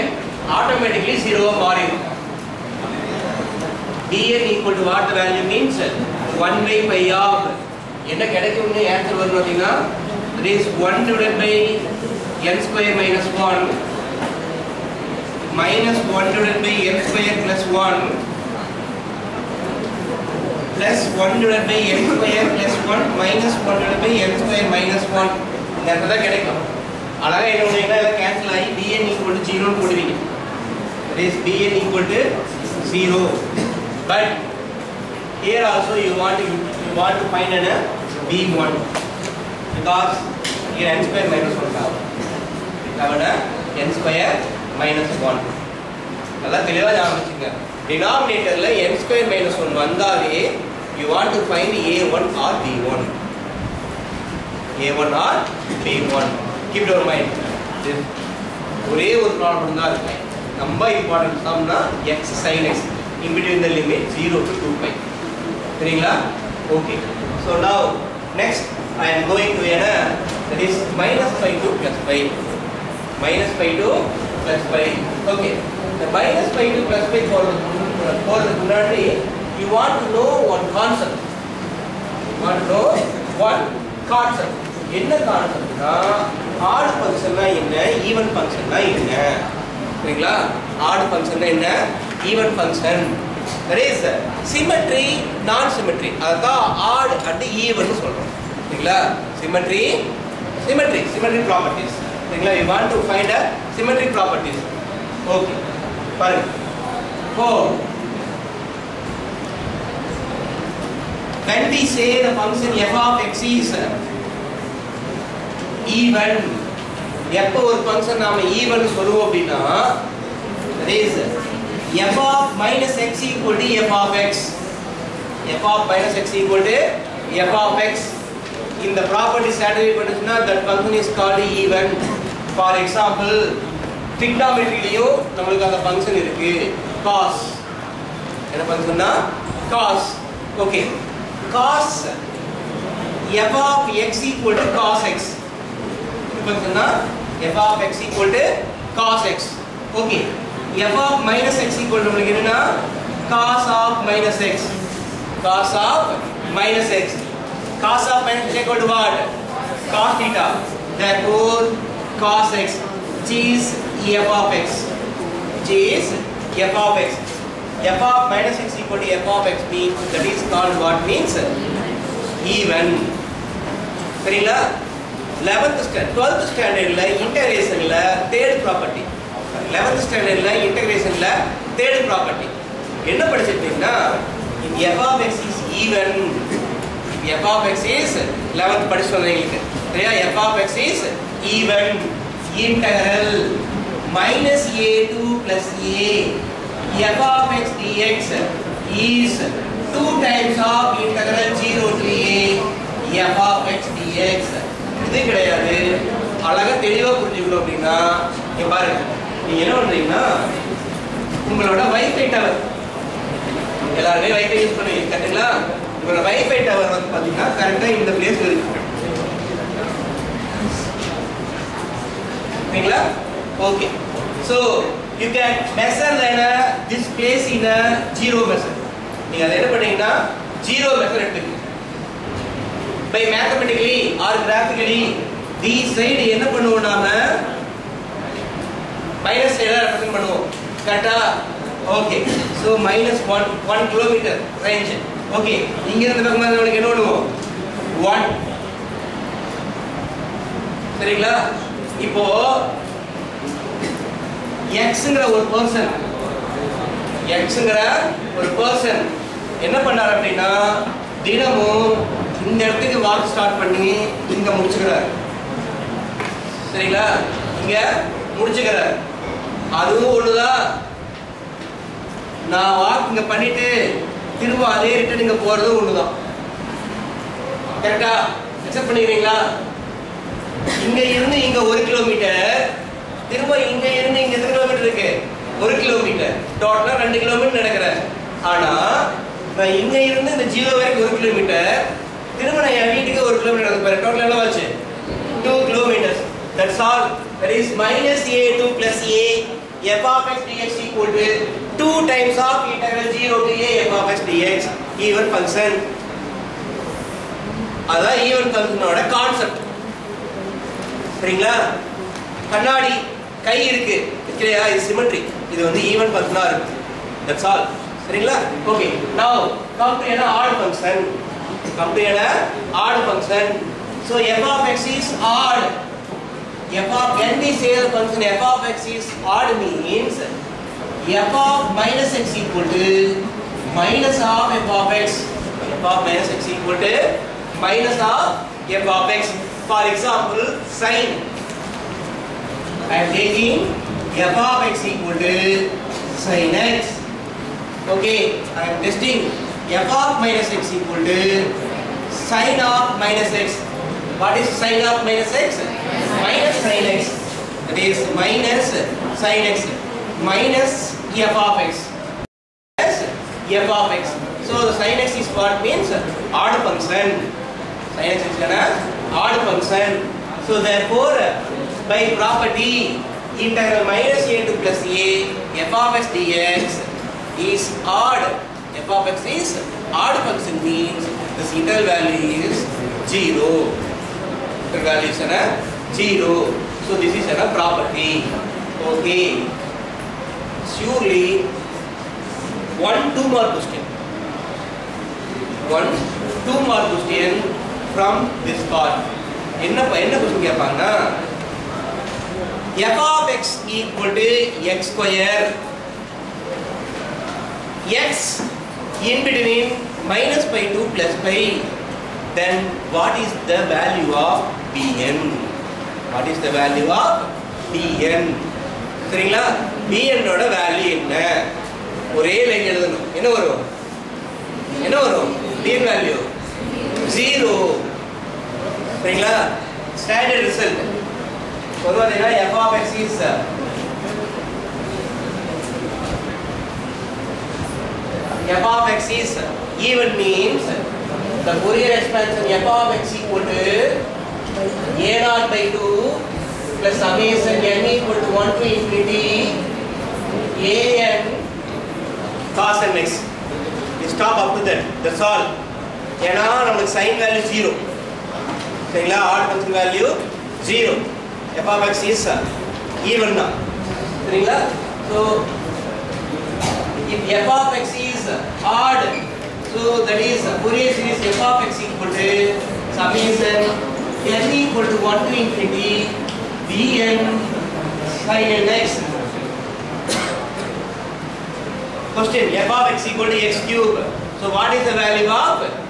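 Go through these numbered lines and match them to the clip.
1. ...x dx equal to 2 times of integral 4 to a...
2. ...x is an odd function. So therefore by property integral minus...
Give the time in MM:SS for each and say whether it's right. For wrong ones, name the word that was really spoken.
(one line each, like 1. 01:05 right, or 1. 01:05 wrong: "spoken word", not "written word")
1. 05:00 wrong: "0", not "4"
2. 06:08 right.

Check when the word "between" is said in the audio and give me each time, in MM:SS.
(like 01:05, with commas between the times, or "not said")
01:03, 06:49.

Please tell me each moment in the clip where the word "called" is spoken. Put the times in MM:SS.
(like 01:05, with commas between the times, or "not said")
02:11, 02:50.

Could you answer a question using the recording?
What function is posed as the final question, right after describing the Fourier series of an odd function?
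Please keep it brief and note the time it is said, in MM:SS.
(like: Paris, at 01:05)
x cube, at 08:03.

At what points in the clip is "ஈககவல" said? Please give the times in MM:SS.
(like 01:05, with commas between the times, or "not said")
00:04, 00:29, 05:32, 05:36.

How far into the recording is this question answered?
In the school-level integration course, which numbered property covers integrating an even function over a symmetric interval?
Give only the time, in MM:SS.
02:58.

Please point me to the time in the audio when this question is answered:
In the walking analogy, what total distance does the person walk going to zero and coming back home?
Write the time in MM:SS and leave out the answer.
04:55.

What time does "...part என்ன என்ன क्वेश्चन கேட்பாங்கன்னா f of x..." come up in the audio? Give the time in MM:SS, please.
06:38.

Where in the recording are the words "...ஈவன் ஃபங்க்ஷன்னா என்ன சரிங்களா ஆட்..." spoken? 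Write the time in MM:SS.
01:28.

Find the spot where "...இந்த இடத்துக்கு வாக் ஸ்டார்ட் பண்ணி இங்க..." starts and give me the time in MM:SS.
04:22.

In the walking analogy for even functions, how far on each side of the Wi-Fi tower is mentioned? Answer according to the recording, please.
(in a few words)
1 kilometre.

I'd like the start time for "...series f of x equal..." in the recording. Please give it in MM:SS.
07:50.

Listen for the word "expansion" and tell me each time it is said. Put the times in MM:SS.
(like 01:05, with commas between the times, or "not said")
07:22.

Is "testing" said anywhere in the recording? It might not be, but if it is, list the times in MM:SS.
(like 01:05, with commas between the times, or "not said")
05:48.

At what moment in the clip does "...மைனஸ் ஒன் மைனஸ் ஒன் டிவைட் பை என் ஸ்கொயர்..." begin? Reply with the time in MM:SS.
00:13.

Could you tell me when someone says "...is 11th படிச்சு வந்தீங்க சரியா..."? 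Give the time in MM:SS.
03:07.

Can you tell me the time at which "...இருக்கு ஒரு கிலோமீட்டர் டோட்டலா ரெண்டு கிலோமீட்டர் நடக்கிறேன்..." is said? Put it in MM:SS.
04:44.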